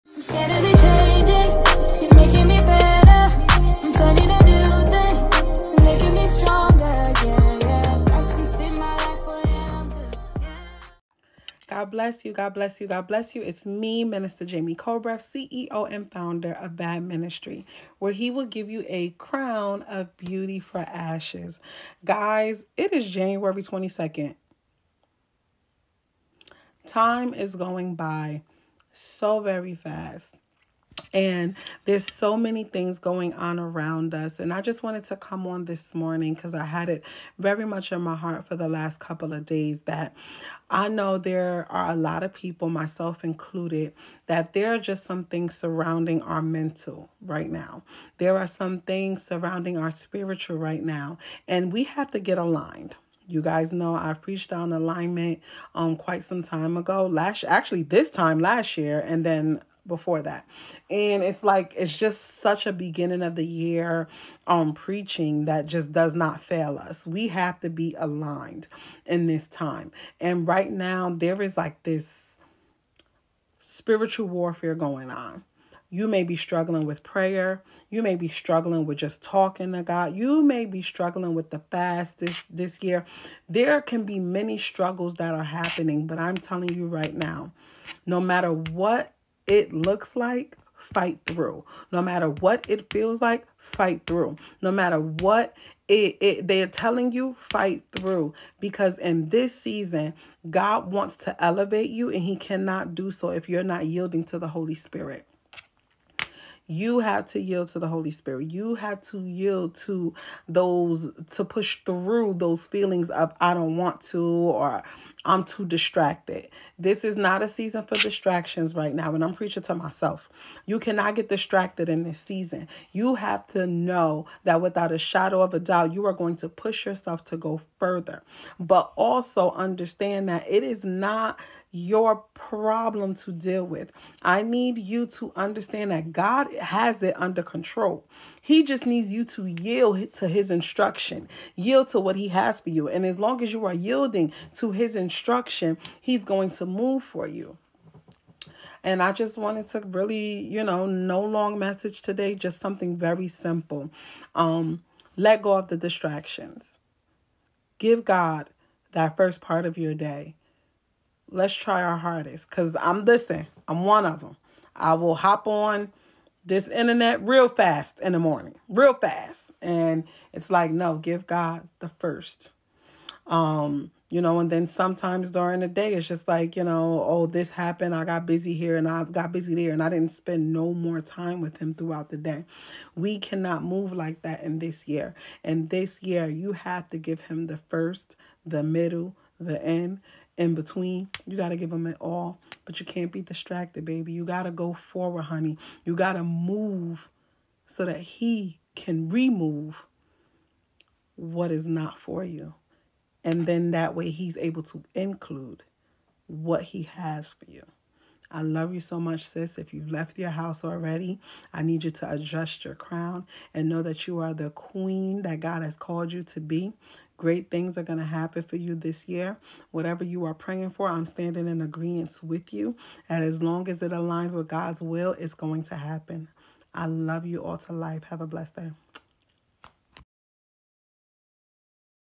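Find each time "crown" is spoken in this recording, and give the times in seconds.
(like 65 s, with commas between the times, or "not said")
19 s, 212 s.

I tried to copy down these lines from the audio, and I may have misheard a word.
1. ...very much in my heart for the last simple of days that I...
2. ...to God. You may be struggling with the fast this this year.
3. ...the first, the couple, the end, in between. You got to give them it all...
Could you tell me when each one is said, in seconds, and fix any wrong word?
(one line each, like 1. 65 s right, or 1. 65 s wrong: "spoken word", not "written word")
1. 37 s wrong: "couple", not "simple"
2. 79 s right
3. 187 s wrong: "middle", not "couple".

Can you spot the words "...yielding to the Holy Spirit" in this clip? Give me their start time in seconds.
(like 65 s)
103 s.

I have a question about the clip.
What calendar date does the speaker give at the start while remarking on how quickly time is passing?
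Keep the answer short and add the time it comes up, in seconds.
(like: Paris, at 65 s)
January 22, at 23 s.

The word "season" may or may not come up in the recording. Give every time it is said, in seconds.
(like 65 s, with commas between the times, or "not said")
99 s, 117 s, 122 s.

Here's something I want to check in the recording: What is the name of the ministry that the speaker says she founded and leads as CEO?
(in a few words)
Bad Ministry.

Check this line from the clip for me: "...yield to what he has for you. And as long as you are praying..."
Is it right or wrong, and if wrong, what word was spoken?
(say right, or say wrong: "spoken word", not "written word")
wrong: "yielding", not "praying".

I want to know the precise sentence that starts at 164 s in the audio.
I will hop on this internet real fast in the morning, real fast.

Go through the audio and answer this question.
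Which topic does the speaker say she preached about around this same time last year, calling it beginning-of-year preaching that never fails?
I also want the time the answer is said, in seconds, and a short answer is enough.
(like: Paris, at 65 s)
Alignment, at 54 s.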